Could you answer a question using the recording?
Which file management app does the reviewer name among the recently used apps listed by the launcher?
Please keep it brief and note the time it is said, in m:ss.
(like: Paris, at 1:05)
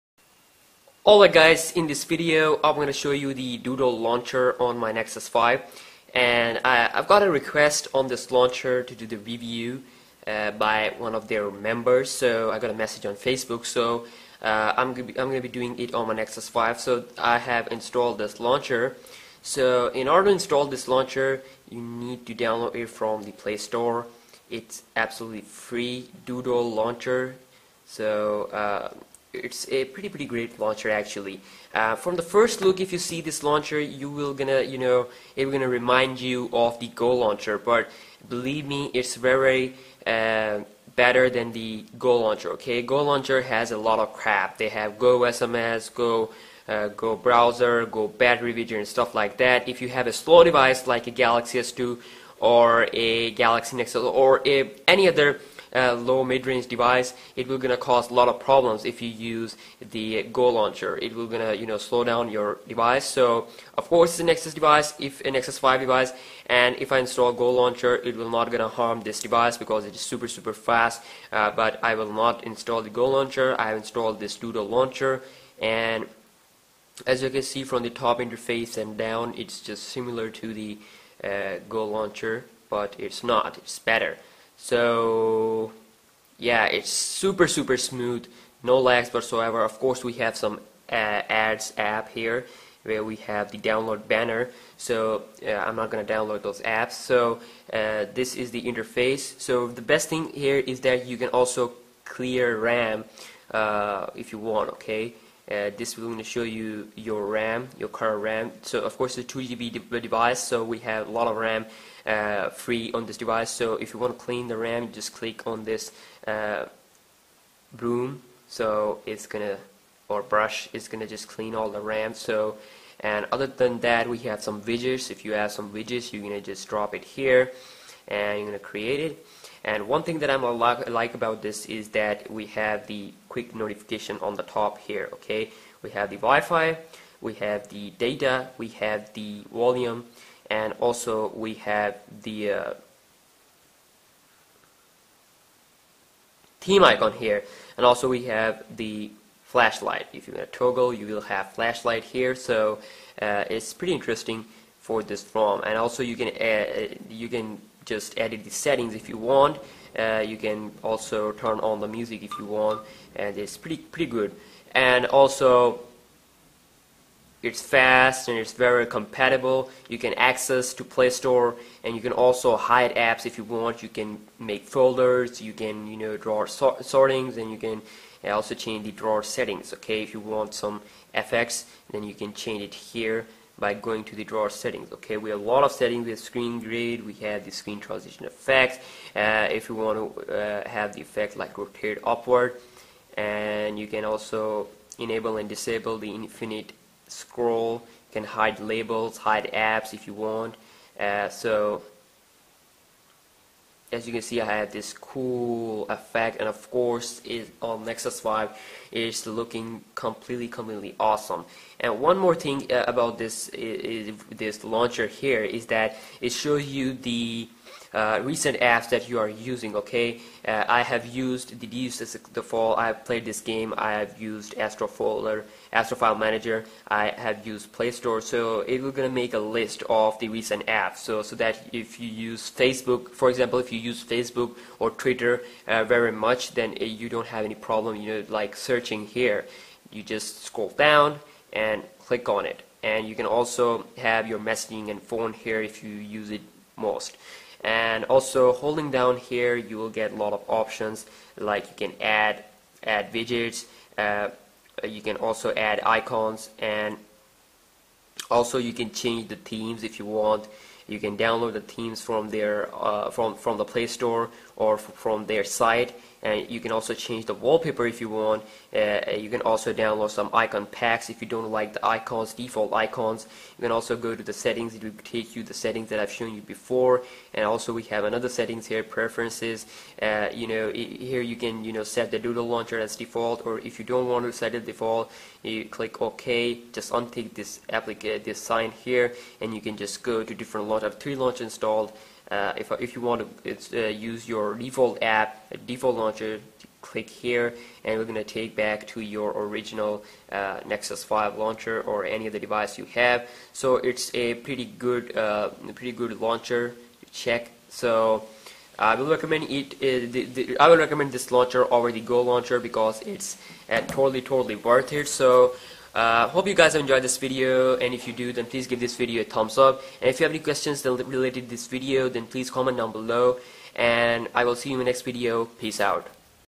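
Astro File Manager, at 3:45.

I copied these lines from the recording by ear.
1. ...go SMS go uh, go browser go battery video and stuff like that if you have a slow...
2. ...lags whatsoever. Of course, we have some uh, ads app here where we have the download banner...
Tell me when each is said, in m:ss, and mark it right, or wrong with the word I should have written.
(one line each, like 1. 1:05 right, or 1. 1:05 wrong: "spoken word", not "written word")
1. 0:44 right
2. 1:28 right.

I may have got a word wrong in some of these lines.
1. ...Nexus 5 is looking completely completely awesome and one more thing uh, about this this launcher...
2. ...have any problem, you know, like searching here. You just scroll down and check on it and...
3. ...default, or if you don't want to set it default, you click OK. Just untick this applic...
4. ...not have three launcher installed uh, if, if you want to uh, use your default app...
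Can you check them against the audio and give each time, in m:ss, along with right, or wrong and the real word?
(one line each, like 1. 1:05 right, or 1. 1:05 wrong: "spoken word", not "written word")
1. 3:27 right
2. 3:57 wrong: "click", not "check"
3. 4:42 right
4. 4:50 right.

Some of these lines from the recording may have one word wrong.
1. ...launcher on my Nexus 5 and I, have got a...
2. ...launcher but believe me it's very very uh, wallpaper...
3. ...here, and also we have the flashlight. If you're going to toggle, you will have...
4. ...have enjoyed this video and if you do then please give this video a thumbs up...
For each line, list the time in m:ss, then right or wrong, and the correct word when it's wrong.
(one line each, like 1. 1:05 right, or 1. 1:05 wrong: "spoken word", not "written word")
1. 0:03 right
2. 0:37 wrong: "better", not "wallpaper"
3. 2:27 right
4. 5:16 right.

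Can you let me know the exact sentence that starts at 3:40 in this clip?
Uh, I have used the DUSIS the fall.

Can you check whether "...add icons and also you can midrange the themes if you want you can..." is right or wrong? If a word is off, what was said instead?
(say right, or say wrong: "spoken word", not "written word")
wrong: "change", not "midrange".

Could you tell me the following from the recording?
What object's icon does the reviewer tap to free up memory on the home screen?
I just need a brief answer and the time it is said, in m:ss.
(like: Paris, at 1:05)
broom, at 1:57.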